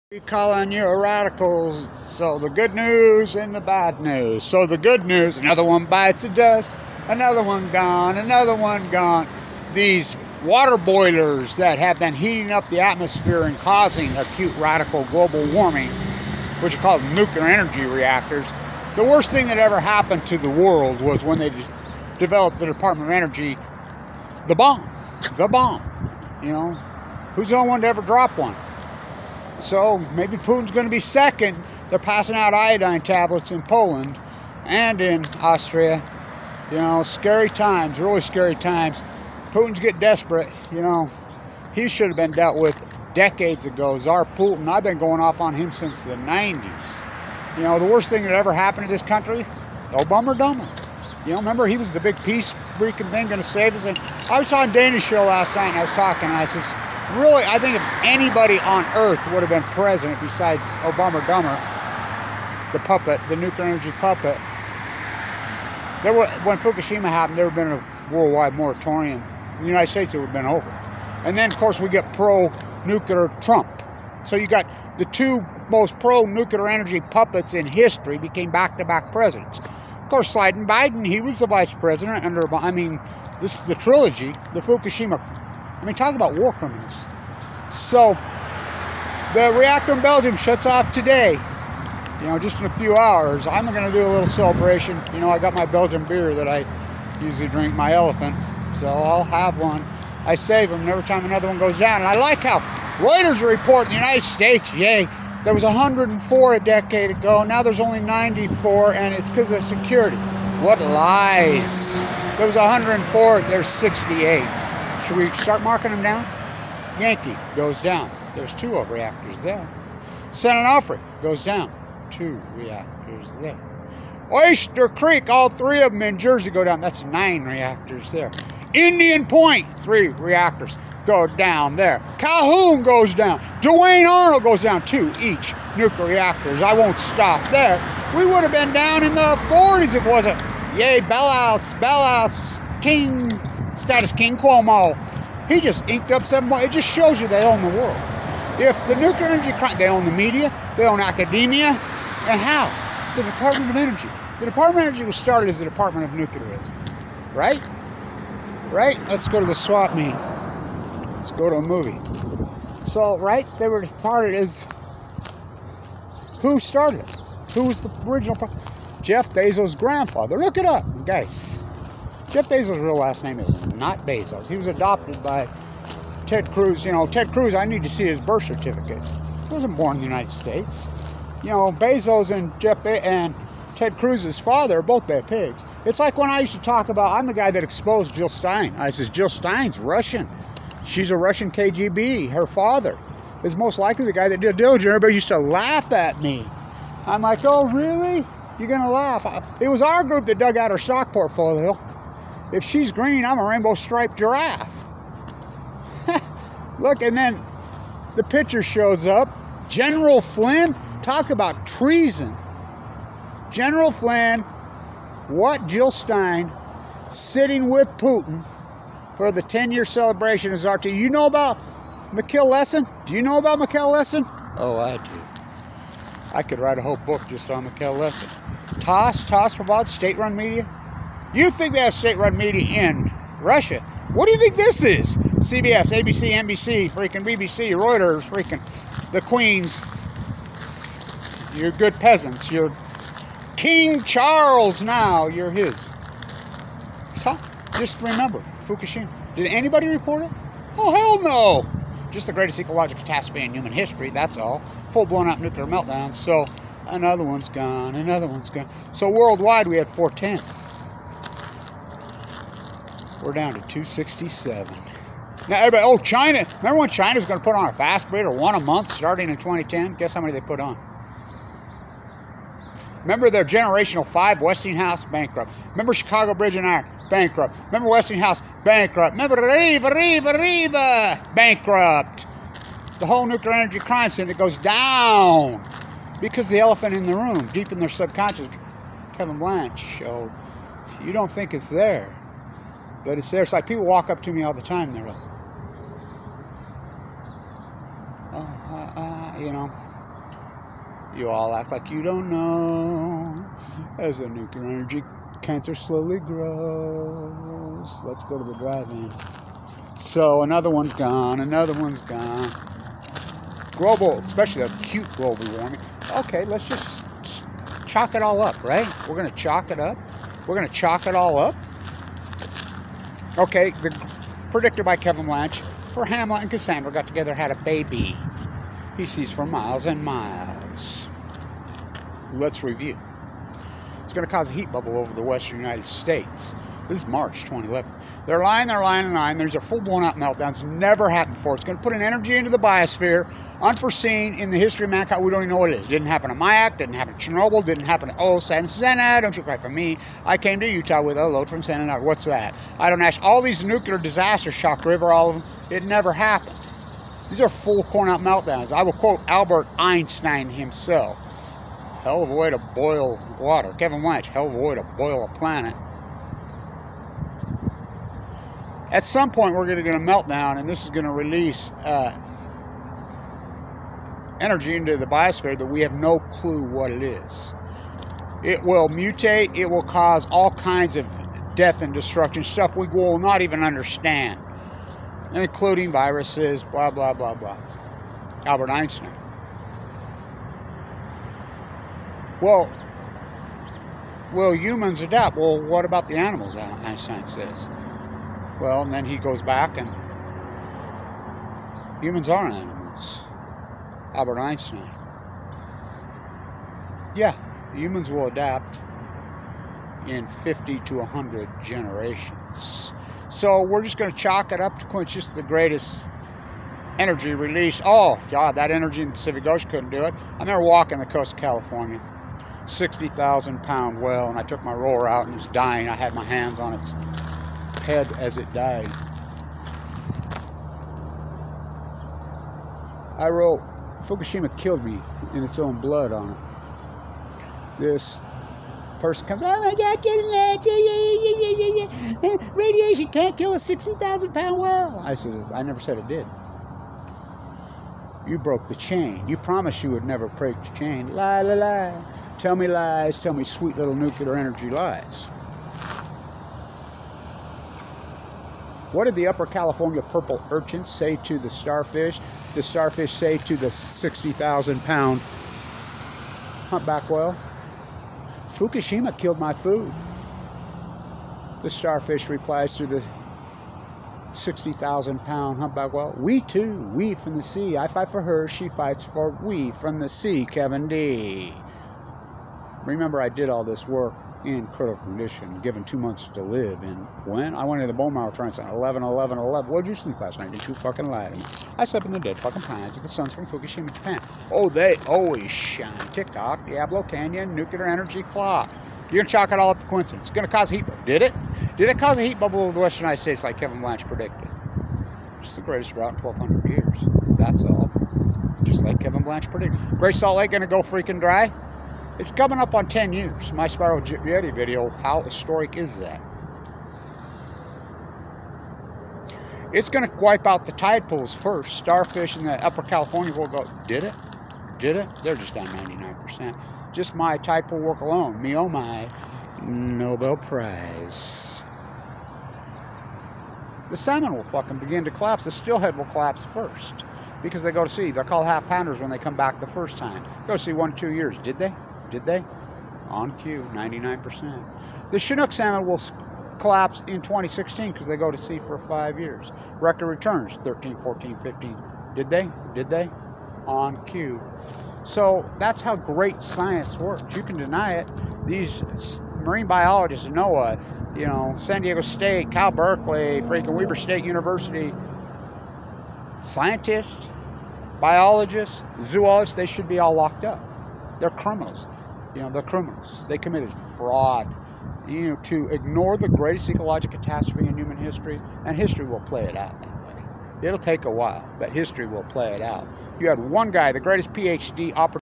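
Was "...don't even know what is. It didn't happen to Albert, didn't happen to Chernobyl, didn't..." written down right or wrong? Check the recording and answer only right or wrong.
wrong.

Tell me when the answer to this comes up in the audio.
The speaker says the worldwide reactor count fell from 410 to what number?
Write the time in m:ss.
4:23.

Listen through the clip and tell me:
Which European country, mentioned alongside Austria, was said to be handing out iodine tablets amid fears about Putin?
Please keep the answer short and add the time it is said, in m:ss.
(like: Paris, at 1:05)
Poland, at 0:33.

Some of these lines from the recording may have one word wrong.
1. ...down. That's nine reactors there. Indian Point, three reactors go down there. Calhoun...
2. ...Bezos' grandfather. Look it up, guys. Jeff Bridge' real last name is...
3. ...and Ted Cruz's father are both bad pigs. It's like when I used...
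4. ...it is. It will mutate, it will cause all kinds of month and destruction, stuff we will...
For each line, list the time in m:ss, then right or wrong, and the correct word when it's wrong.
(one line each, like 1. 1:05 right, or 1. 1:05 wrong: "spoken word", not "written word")
1. 2:06 right
2. 2:49 wrong: "Bezos", not "Bridge"
3. 3:02 right
4. 6:16 wrong: "death", not "month".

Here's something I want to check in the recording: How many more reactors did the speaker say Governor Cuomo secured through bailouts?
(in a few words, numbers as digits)
7.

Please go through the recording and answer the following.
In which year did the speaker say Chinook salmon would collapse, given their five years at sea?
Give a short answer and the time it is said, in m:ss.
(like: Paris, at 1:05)
2016, at 9:07.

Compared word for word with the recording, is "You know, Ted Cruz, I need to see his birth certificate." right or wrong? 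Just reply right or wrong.
right.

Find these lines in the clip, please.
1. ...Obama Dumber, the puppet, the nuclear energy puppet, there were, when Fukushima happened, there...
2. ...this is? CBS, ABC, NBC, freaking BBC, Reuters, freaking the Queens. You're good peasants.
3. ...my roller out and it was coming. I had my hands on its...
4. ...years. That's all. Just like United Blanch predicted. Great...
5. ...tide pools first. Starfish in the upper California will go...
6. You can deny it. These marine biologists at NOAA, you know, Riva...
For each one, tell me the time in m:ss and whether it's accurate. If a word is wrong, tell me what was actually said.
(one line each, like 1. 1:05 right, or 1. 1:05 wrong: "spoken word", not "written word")
1. 1:00 right
2. 3:54 right
3. 7:04 wrong: "dying", not "coming"
4. 8:26 wrong: "Kevin", not "United"
5. 8:40 right
6. 9:17 wrong: "San", not "Riva".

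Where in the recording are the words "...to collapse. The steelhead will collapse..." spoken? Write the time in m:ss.
8:55.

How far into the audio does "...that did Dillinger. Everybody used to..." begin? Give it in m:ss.
3:14.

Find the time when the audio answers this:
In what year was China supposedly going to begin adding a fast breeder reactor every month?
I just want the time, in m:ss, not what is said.
4:29.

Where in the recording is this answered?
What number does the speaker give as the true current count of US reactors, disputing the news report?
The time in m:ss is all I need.
1:53.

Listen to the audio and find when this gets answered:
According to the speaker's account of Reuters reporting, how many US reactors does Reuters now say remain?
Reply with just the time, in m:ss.
1:47.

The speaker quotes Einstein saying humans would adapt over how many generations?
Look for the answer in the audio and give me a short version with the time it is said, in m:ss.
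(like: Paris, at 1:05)
50 to 100, at 6:50.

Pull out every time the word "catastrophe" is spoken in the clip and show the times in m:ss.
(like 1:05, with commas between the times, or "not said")
4:13, 9:37.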